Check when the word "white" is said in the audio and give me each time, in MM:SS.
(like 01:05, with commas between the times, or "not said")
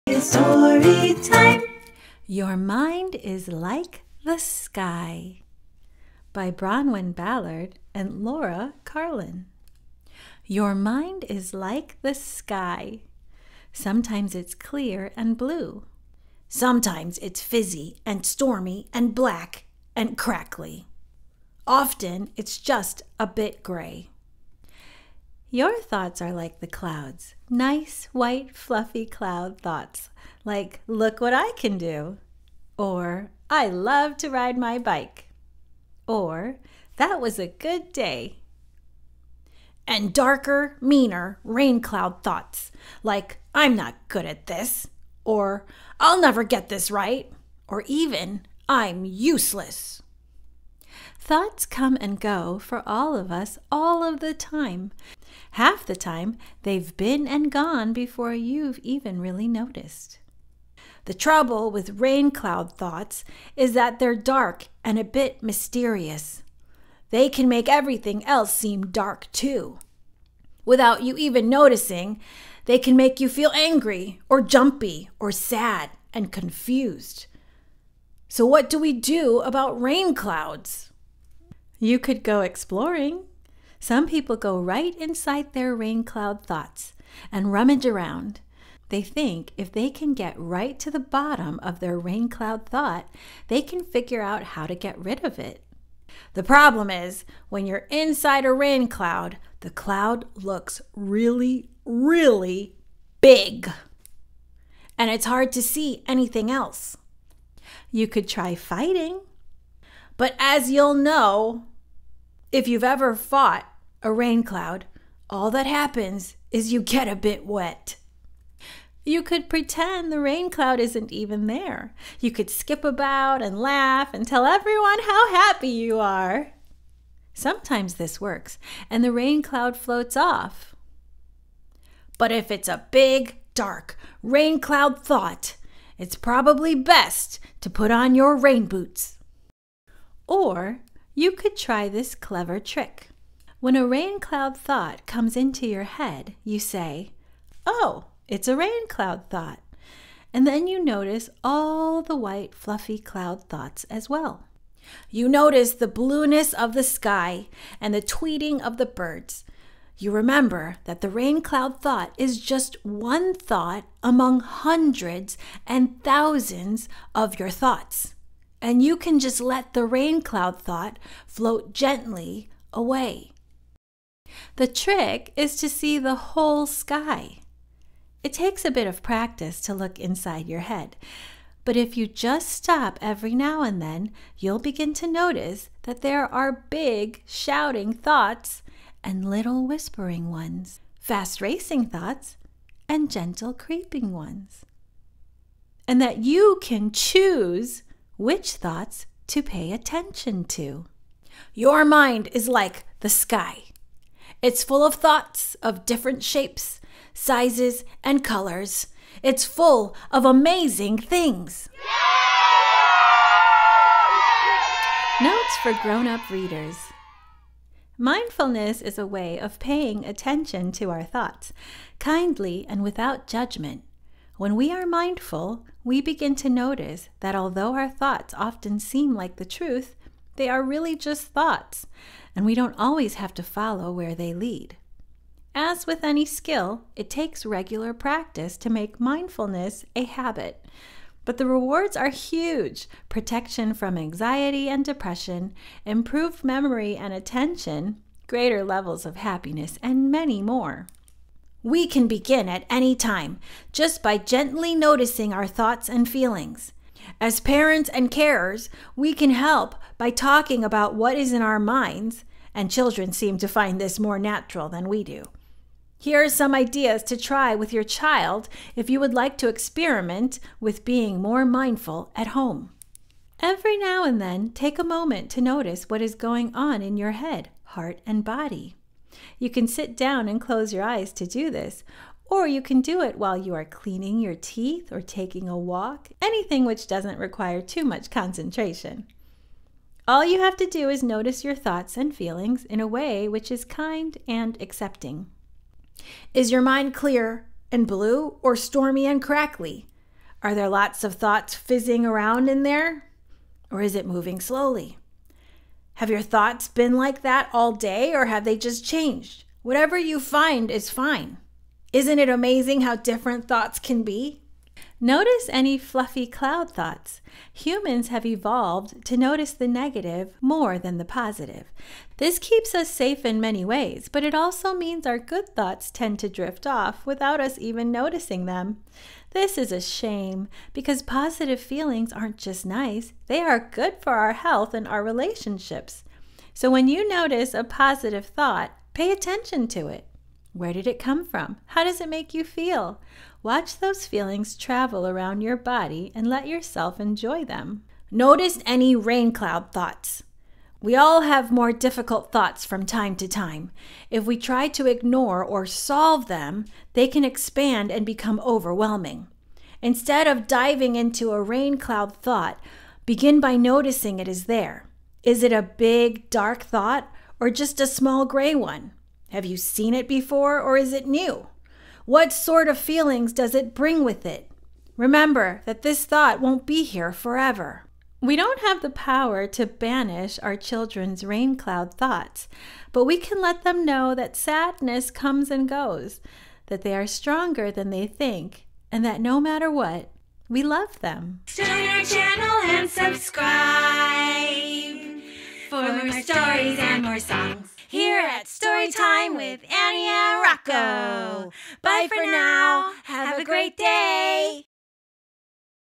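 00:28, 02:32.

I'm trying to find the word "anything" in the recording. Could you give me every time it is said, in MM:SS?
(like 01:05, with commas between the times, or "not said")
01:46, 04:46.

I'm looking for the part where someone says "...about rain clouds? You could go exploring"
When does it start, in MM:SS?
01:19.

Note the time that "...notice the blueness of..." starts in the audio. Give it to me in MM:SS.
02:35.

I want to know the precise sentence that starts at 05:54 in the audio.
If we try to ignore or solve them, they can expand and become overwhelming.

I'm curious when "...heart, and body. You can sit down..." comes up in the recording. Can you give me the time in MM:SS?
04:37.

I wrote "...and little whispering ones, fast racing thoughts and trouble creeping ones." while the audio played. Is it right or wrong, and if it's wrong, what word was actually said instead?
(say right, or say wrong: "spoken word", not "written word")
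wrong: "gentle", not "trouble".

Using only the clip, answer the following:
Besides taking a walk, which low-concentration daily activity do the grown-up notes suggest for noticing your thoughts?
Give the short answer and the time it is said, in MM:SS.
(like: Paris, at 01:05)
cleaning your teeth, at 04:43.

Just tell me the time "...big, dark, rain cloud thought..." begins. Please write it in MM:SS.
02:12.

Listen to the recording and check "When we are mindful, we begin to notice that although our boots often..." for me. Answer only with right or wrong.
wrong.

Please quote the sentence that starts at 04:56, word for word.
Is your mind clear and blue or stormy and crackly?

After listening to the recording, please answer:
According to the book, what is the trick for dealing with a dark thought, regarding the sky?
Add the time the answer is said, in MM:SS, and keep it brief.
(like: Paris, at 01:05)
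see the whole sky, at 02:55.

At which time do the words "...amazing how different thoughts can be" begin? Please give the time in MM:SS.
05:12.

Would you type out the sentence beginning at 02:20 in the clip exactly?
Or you could try this clever trick.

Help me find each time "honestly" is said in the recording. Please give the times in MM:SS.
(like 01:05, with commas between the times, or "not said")
not said.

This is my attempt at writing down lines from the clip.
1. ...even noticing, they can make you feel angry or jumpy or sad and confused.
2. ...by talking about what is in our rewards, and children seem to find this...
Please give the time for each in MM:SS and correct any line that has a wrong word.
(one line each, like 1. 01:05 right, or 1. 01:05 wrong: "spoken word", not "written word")
1. 01:11 right
2. 04:19 wrong: "minds", not "rewards".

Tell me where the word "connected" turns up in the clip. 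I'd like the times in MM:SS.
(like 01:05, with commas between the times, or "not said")
not said.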